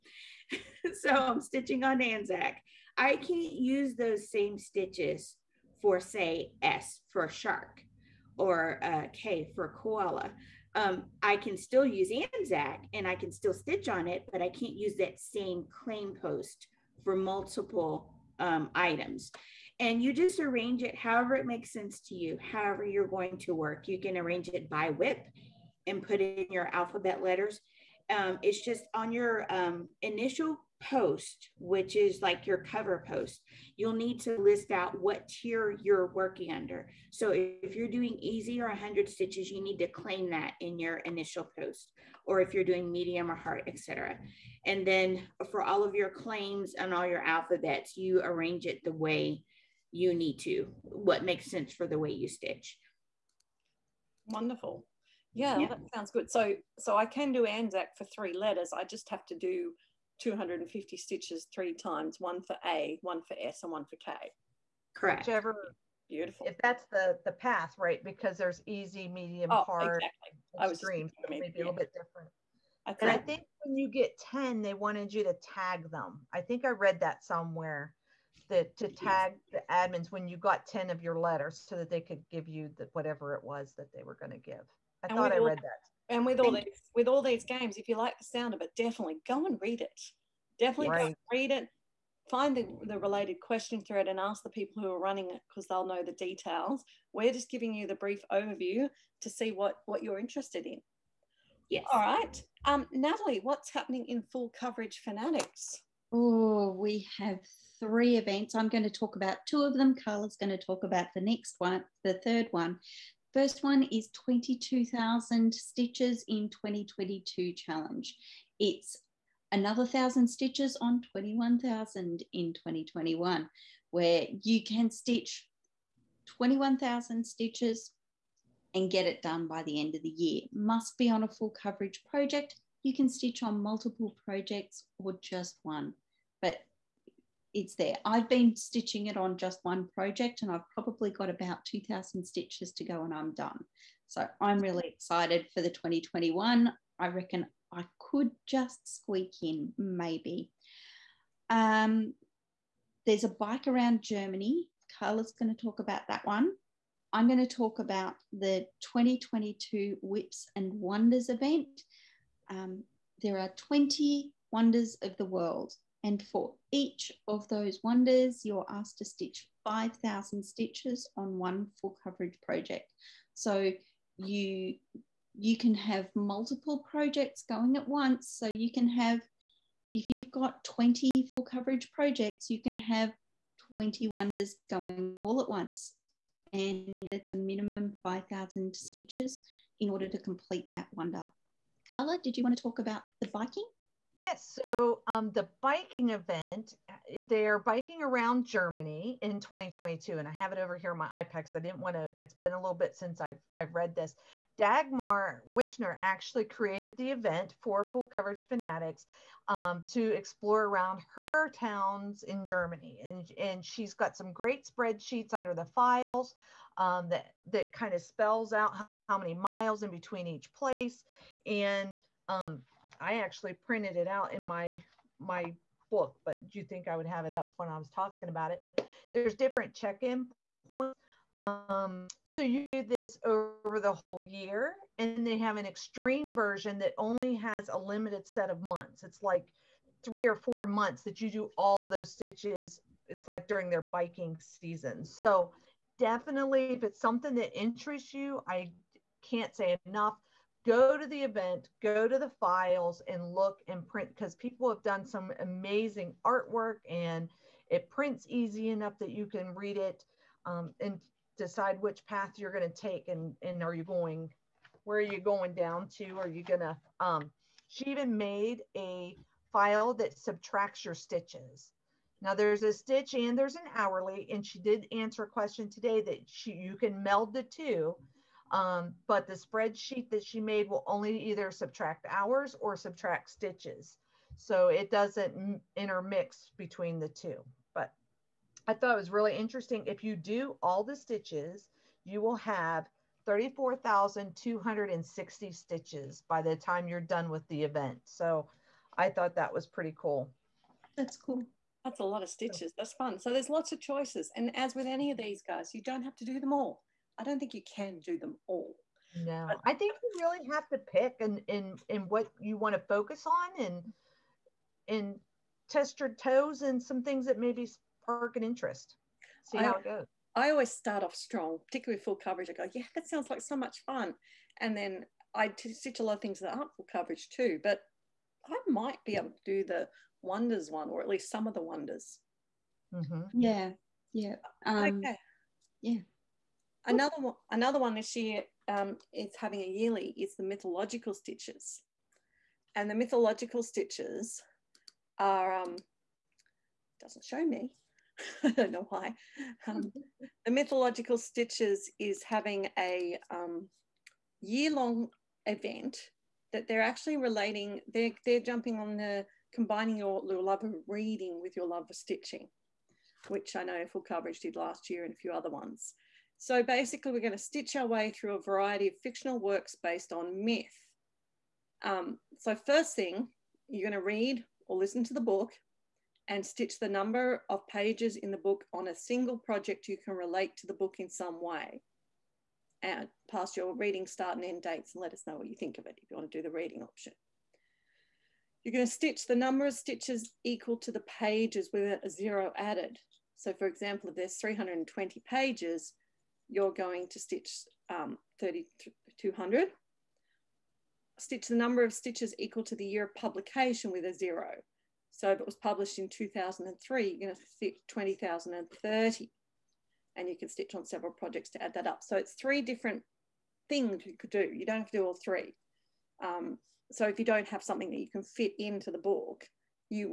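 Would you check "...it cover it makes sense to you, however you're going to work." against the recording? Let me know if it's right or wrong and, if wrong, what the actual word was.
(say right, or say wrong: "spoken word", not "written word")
wrong: "however", not "cover".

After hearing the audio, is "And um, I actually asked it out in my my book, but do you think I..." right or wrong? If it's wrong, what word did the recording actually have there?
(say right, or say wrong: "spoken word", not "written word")
wrong: "printed", not "asked".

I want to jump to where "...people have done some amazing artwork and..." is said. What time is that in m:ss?
4:14.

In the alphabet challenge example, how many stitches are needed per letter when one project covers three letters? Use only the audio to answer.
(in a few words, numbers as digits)
250.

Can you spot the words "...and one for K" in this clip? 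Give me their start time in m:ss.
1:03.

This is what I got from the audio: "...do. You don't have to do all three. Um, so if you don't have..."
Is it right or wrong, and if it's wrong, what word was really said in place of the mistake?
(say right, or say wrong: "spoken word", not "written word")
right.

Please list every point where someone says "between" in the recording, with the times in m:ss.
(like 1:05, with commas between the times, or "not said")
3:39, 4:46.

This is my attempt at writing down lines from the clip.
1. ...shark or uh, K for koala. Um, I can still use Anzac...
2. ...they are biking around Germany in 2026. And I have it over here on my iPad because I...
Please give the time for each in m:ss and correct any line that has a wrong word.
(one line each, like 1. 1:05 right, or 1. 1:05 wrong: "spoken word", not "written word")
1. 0:07 right
2. 3:17 wrong: "2022", not "2026".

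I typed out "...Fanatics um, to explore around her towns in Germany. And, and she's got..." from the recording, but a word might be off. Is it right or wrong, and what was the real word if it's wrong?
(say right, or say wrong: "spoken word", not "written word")
right.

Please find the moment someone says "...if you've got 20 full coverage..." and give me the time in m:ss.
2:59.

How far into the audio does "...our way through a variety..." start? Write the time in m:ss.
6:07.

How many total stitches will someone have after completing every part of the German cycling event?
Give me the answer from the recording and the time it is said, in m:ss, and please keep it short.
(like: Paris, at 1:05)
34,260, at 4:53.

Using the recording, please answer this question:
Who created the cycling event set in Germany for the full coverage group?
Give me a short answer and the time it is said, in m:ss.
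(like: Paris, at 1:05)
Dagmar Wichner, at 3:24.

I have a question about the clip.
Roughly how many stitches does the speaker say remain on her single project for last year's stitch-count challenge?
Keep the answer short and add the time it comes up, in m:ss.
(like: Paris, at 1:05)
2,000, at 2:21.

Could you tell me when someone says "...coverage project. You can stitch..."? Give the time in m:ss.
2:11.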